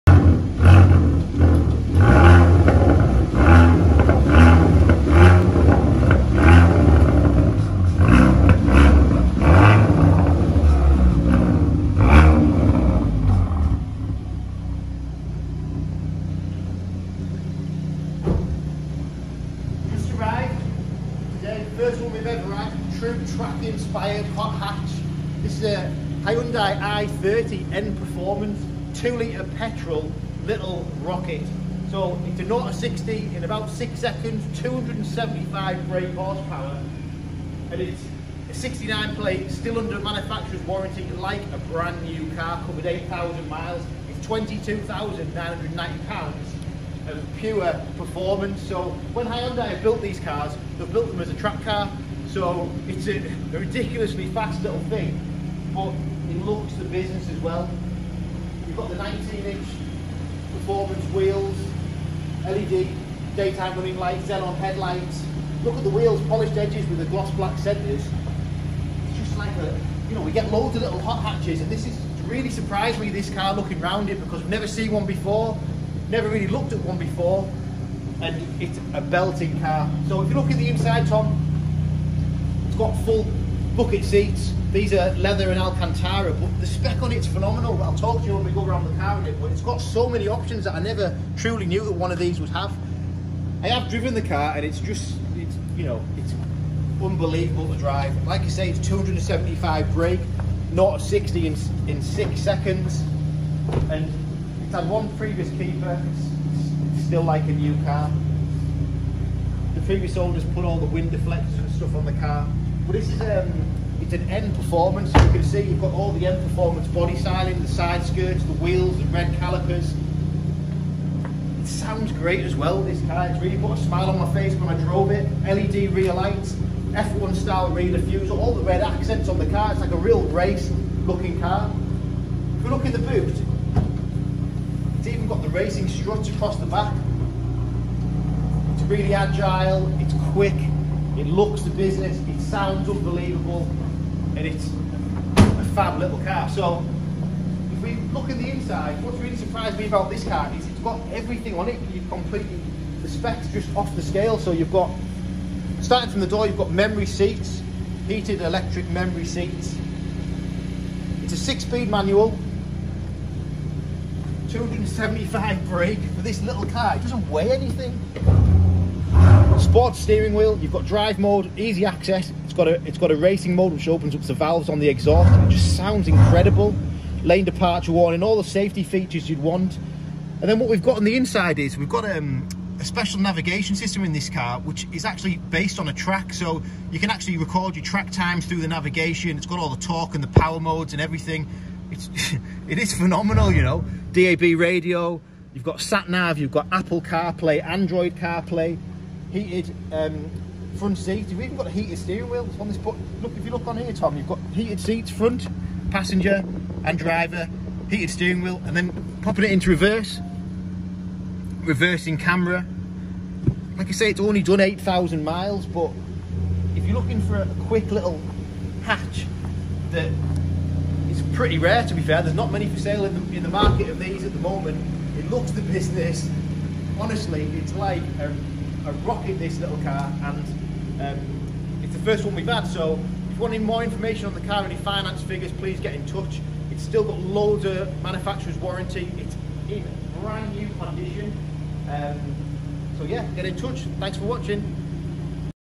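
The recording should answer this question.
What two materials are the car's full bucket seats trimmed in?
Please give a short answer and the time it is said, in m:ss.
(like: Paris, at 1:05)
Leather and Alcantara, at 1:25.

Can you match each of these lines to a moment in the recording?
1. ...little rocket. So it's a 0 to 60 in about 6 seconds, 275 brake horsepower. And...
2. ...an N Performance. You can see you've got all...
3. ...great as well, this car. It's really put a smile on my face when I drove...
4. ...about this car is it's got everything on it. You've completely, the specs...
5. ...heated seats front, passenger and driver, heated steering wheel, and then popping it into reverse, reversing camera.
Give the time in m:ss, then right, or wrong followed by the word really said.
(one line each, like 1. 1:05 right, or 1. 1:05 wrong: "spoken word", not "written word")
1. 0:30 right
2. 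1:54 right
3. 2:02 right
4. 2:29 right
5. 3:24 right.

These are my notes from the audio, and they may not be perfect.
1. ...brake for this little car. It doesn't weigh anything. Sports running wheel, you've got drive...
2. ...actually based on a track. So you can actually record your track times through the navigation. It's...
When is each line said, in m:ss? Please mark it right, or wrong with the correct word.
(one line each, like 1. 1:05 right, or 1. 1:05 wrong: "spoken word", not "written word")
1. 2:45 wrong: "steering", not "running"
2. 3:05 right.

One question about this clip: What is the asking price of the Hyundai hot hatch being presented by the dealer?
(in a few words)
£22,990.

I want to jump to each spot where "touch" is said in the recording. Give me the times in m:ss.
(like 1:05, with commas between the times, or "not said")
3:56, 4:03.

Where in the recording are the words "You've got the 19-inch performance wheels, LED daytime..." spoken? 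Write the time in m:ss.
0:58.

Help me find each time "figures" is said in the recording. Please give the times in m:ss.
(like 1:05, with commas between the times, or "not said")
3:55.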